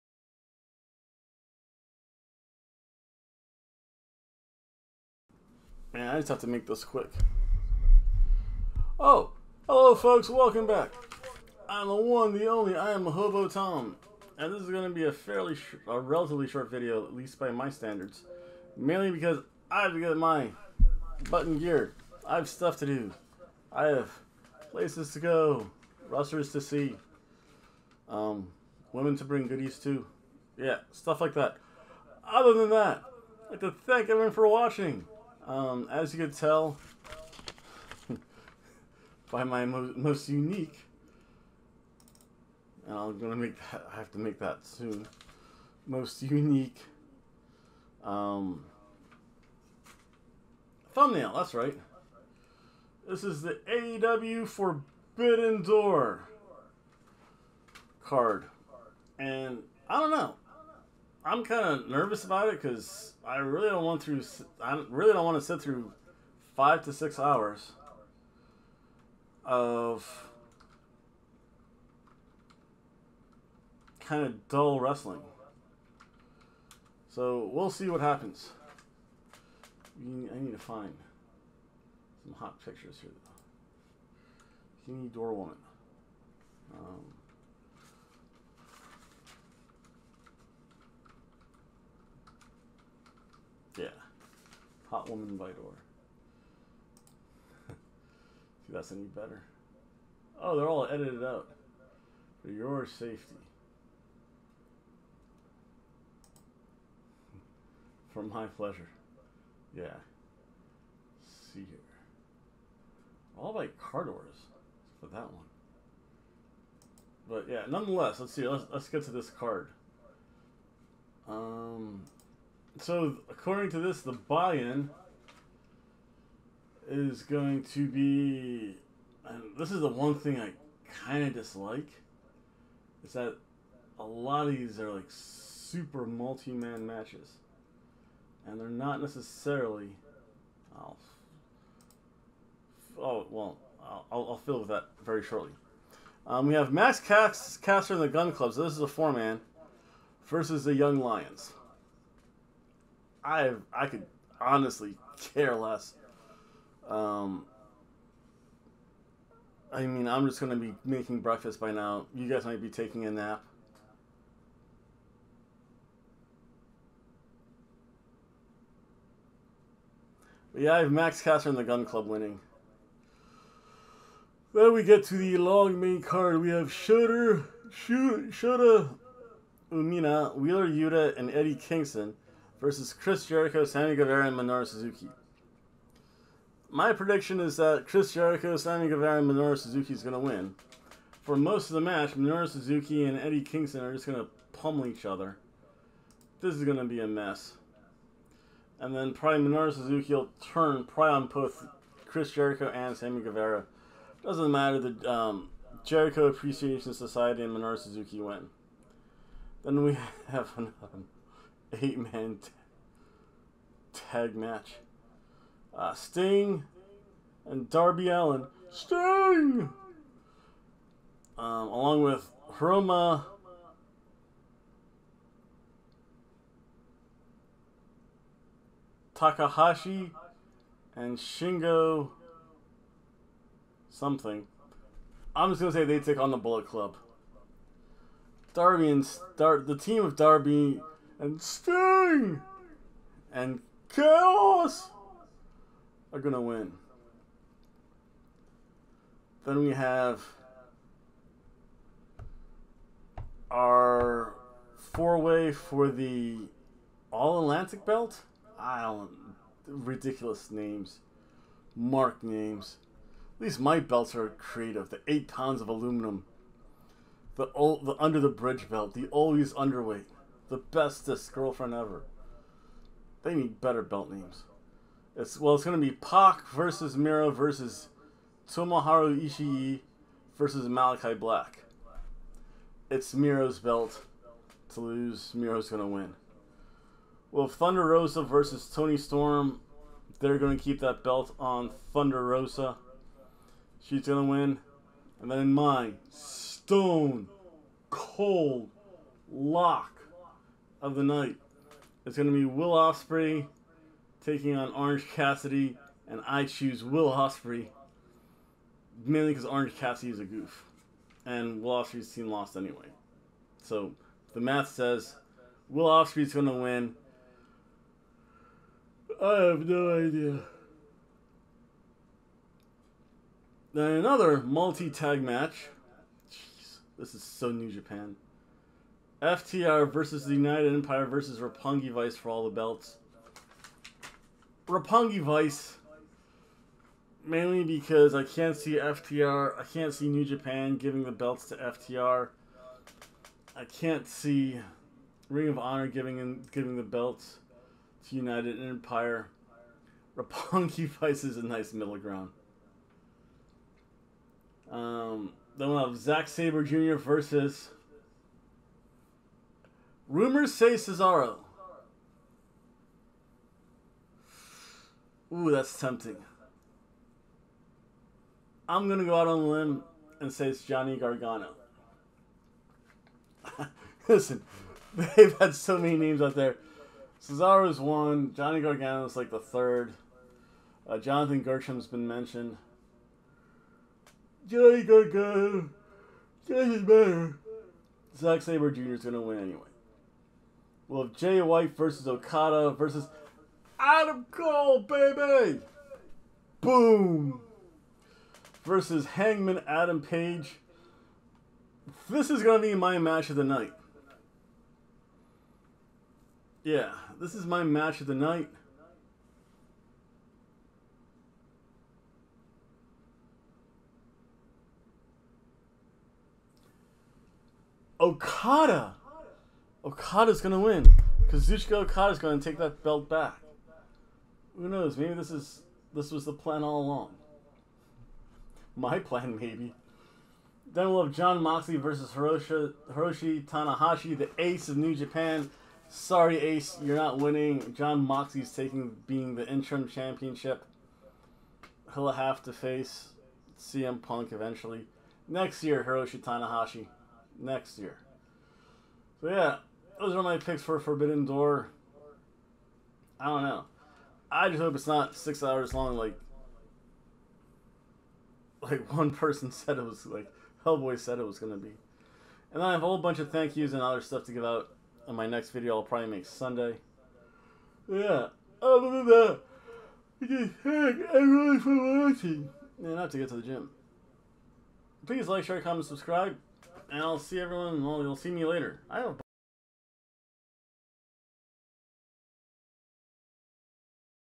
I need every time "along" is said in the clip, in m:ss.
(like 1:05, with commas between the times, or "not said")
3:41, 7:06.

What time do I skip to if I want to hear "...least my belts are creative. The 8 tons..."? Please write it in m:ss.
4:23.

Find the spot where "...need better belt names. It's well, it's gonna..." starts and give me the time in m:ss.
4:33.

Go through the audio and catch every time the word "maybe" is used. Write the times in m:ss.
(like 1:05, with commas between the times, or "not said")
7:04, 7:09.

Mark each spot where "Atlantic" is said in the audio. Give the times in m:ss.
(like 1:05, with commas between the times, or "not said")
4:17.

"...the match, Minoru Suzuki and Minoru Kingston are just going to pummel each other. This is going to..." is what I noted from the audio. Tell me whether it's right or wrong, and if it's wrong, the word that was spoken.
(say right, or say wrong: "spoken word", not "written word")
wrong: "Eddie", not "Minoru".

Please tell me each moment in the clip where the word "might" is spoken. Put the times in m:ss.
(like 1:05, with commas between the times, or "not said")
2:42.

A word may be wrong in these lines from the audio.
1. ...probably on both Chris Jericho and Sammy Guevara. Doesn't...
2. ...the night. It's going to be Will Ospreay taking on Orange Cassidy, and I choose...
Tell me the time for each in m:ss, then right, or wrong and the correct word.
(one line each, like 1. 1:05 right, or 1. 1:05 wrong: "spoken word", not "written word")
1. 3:20 right
2. 5:00 right.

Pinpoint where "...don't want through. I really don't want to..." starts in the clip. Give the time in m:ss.
1:03.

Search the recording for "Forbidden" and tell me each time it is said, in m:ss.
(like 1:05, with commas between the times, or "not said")
0:54, 7:30.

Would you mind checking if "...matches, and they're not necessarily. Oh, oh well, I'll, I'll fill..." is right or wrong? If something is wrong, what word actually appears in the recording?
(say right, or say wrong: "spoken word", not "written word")
right.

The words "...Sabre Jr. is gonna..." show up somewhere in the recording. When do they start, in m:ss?
6:28.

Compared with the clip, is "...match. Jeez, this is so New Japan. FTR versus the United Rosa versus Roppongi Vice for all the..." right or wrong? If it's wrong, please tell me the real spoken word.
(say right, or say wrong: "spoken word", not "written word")
wrong: "Empire", not "Rosa".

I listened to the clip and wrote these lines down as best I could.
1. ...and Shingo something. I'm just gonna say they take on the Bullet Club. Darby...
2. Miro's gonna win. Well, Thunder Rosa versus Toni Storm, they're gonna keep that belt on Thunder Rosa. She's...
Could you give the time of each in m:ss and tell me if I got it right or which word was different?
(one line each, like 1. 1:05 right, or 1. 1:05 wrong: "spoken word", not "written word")
1. 3:50 right
2. 4:45 right.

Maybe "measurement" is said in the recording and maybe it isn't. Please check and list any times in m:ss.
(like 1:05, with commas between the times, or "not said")
not said.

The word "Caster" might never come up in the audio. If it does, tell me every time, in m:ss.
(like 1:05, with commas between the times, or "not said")
2:27, 2:51.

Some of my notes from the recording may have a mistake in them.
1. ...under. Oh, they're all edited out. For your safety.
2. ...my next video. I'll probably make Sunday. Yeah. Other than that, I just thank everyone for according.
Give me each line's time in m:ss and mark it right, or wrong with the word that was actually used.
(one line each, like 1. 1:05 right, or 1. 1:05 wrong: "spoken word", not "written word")
1. 1:39 wrong: "better", not "under"
2. 7:45 wrong: "watching", not "according".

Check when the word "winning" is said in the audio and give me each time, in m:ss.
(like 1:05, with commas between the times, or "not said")
2:52, 7:17.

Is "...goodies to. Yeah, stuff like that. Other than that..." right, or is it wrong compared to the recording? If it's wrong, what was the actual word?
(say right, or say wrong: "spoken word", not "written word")
right.